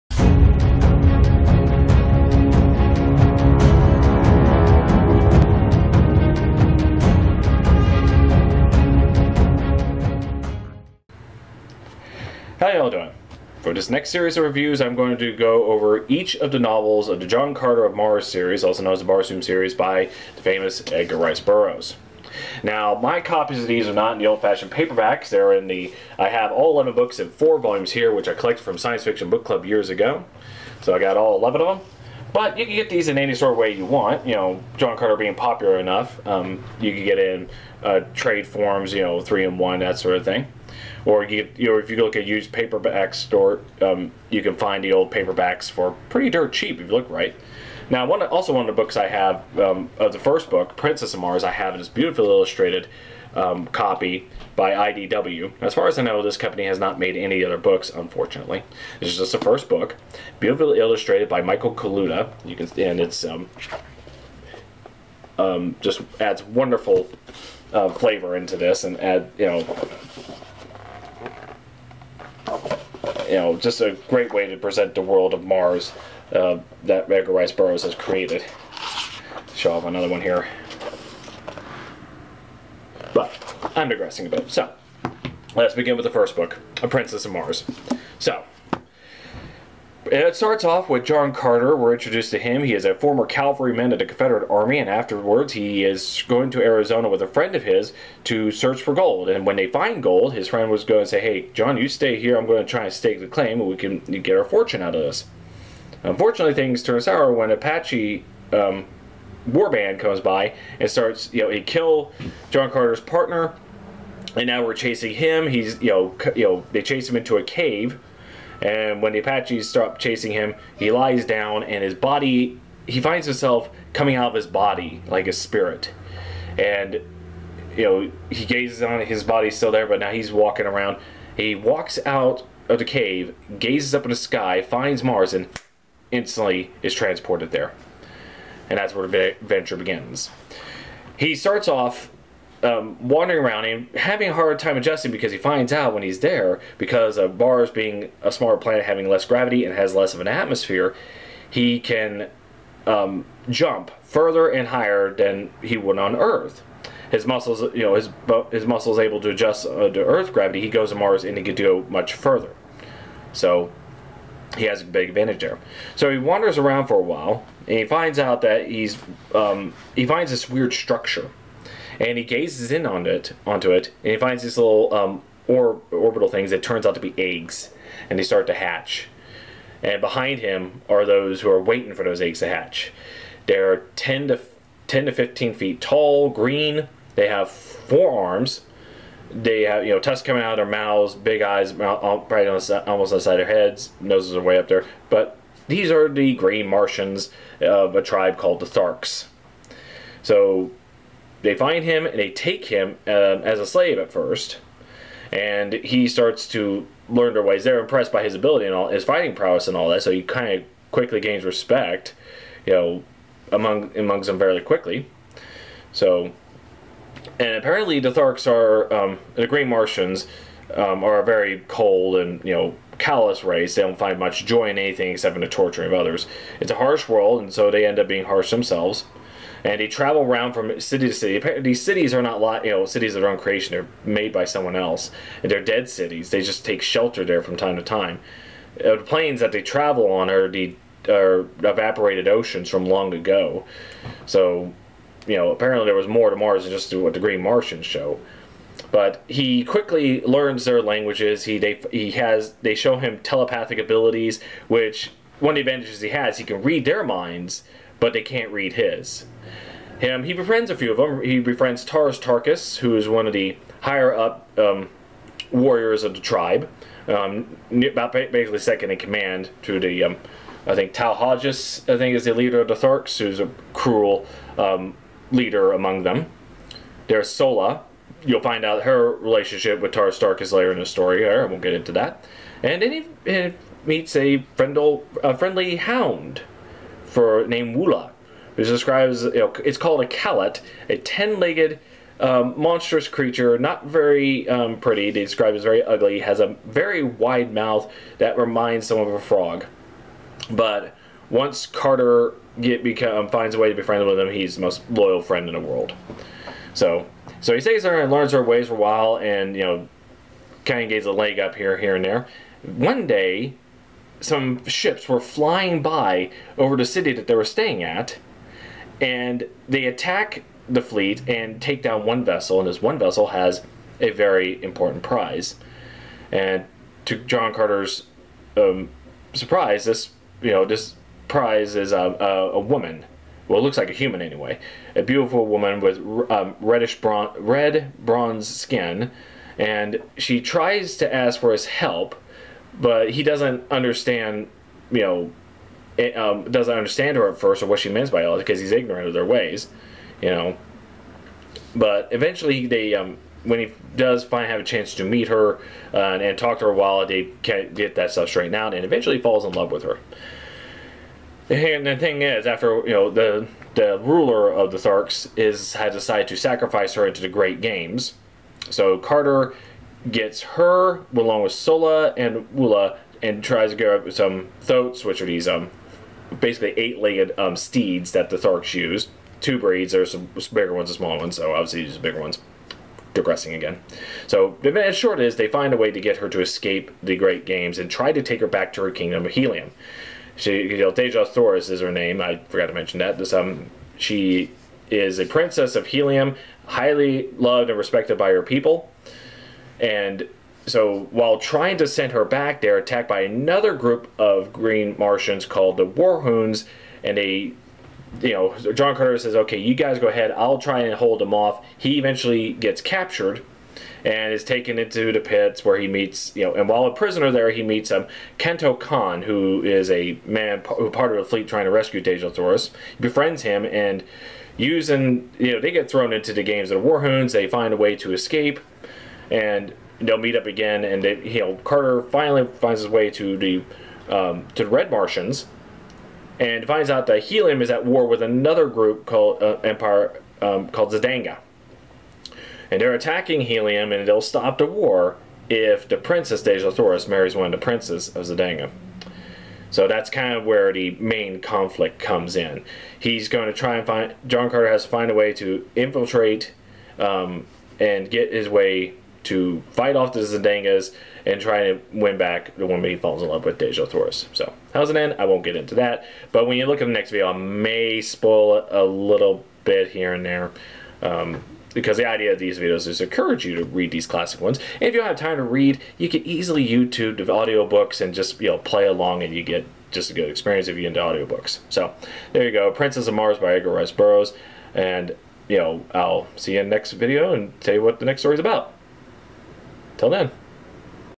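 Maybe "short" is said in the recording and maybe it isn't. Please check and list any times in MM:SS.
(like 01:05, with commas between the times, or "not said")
06:24.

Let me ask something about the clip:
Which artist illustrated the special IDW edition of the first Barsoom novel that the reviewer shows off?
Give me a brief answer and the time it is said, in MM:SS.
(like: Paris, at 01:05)
Michael Kaluta, at 01:01.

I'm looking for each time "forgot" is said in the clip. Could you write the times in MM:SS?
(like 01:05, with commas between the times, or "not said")
06:32.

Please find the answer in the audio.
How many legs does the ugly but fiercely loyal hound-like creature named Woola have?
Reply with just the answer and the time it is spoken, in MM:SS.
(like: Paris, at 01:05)
10, at 04:50.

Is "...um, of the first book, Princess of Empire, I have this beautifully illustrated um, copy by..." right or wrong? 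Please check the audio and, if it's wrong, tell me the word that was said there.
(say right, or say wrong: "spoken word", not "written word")
wrong: "Mars", not "Empire".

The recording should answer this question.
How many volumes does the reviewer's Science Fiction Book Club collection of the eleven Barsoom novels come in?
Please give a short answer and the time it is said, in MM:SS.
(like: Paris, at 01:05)
4, at 00:27.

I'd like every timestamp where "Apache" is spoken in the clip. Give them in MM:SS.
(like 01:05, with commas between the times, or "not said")
01:47, 01:59.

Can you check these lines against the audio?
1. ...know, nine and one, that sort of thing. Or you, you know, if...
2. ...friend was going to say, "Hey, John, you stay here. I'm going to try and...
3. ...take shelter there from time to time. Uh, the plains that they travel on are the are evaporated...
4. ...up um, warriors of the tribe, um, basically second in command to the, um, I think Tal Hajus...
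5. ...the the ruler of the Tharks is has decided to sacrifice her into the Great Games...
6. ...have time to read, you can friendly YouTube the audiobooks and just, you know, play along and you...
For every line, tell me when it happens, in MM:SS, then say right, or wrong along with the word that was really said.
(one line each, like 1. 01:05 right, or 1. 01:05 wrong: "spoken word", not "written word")
1. 00:39 wrong: "three", not "nine"
2. 01:40 right
3. 03:56 right
4. 04:24 right
5. 06:03 right
6. 07:55 wrong: "easily", not "friendly".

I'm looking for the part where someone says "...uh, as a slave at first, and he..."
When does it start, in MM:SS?
03:23.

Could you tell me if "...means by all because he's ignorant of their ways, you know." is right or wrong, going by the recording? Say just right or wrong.
right.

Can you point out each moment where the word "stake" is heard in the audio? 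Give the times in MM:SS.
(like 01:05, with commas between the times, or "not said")
01:42.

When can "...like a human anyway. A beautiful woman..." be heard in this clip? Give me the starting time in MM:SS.
05:33.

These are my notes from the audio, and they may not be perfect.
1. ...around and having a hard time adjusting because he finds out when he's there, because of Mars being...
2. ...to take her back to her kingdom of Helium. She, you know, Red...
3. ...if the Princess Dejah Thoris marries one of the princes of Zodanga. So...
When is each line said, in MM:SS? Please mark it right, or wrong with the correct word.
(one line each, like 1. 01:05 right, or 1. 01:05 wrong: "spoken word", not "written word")
1. 02:23 right
2. 06:28 wrong: "Dejah", not "Red"
3. 07:25 right.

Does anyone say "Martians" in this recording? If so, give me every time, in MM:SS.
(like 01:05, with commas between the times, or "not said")
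03:16, 03:39, 04:07, 06:44, 07:14.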